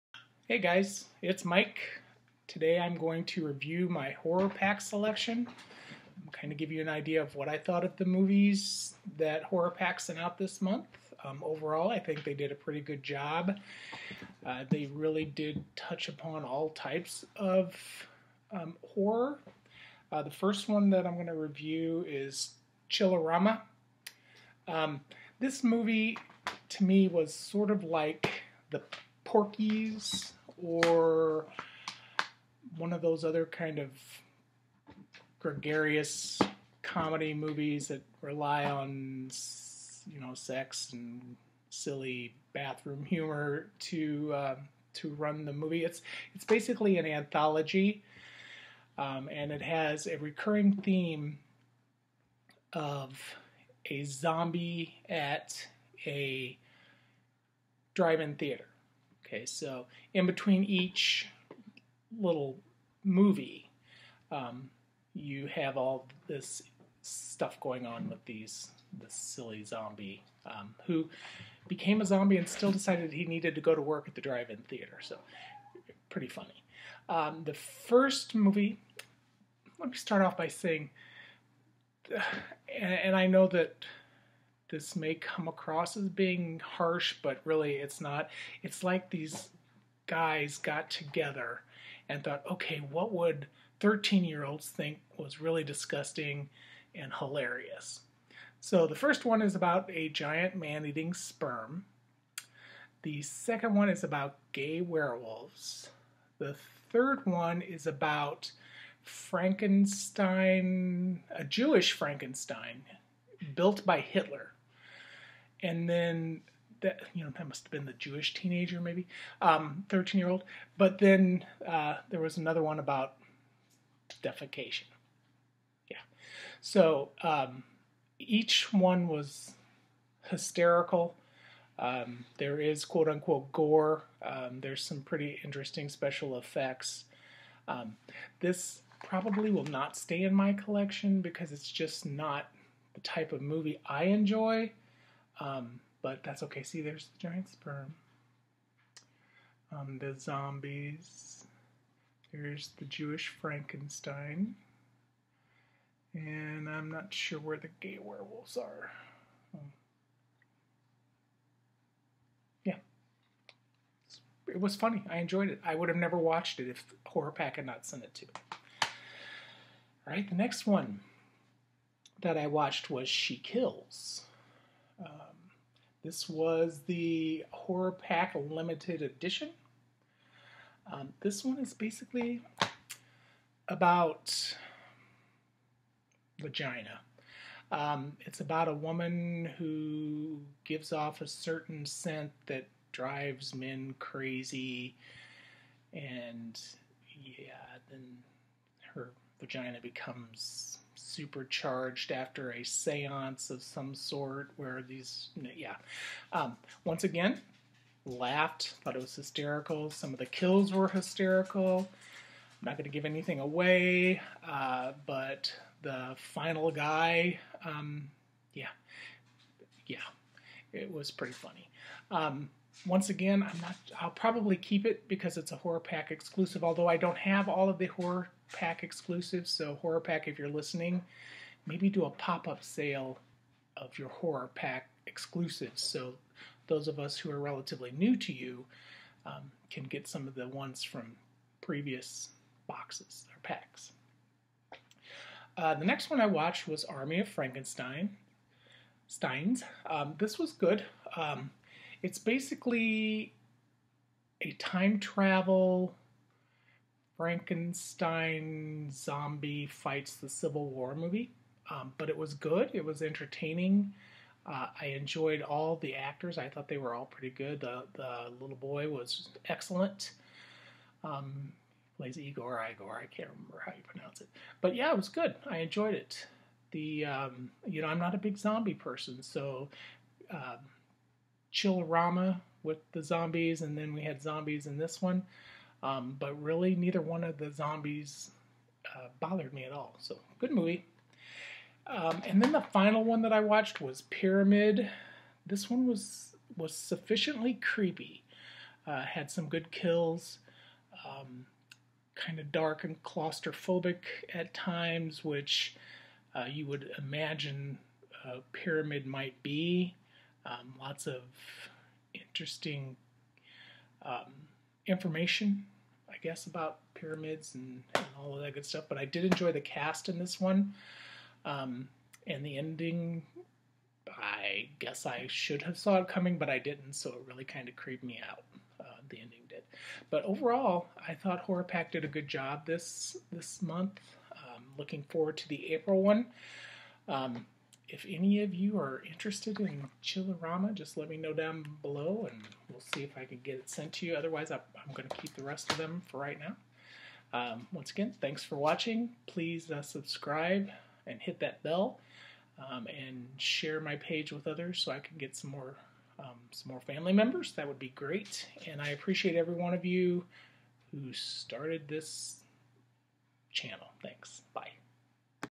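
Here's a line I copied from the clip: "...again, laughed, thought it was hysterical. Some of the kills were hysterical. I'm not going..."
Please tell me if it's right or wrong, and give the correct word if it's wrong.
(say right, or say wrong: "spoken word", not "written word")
right.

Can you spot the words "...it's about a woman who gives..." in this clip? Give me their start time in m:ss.
3:08.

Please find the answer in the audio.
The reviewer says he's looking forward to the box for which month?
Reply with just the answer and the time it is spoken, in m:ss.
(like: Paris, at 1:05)
April, at 5:35.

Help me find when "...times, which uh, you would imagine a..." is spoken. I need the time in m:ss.
5:04.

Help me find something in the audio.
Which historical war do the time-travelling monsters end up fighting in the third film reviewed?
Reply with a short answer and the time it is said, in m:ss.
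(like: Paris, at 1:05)
the Civil War, at 4:20.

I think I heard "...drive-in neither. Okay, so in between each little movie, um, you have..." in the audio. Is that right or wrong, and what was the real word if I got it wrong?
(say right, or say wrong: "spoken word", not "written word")
wrong: "theater", not "neither".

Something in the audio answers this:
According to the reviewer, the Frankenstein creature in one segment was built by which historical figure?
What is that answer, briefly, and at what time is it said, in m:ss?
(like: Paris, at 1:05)
Hitler, at 1:53.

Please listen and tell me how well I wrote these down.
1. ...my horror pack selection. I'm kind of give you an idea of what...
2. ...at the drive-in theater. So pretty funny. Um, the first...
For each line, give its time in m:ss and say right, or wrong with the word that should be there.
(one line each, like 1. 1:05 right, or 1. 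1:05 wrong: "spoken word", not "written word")
1. 0:03 right
2. 1:14 right.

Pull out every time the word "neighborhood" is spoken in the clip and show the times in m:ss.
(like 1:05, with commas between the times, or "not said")
not said.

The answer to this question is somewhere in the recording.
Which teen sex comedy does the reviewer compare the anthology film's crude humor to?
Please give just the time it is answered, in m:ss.
0:29.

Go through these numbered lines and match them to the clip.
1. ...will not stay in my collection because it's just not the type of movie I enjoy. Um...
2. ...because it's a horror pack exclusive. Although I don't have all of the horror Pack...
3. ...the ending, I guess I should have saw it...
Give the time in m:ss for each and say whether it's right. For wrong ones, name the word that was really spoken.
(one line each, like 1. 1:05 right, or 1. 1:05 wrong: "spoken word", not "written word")
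1. 2:19 right
2. 3:45 right
3. 5:22 right.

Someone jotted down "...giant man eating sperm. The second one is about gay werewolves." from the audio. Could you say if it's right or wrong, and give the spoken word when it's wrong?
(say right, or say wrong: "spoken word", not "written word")
right.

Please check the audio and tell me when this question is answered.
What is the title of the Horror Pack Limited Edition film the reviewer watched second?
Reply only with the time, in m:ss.
2:53.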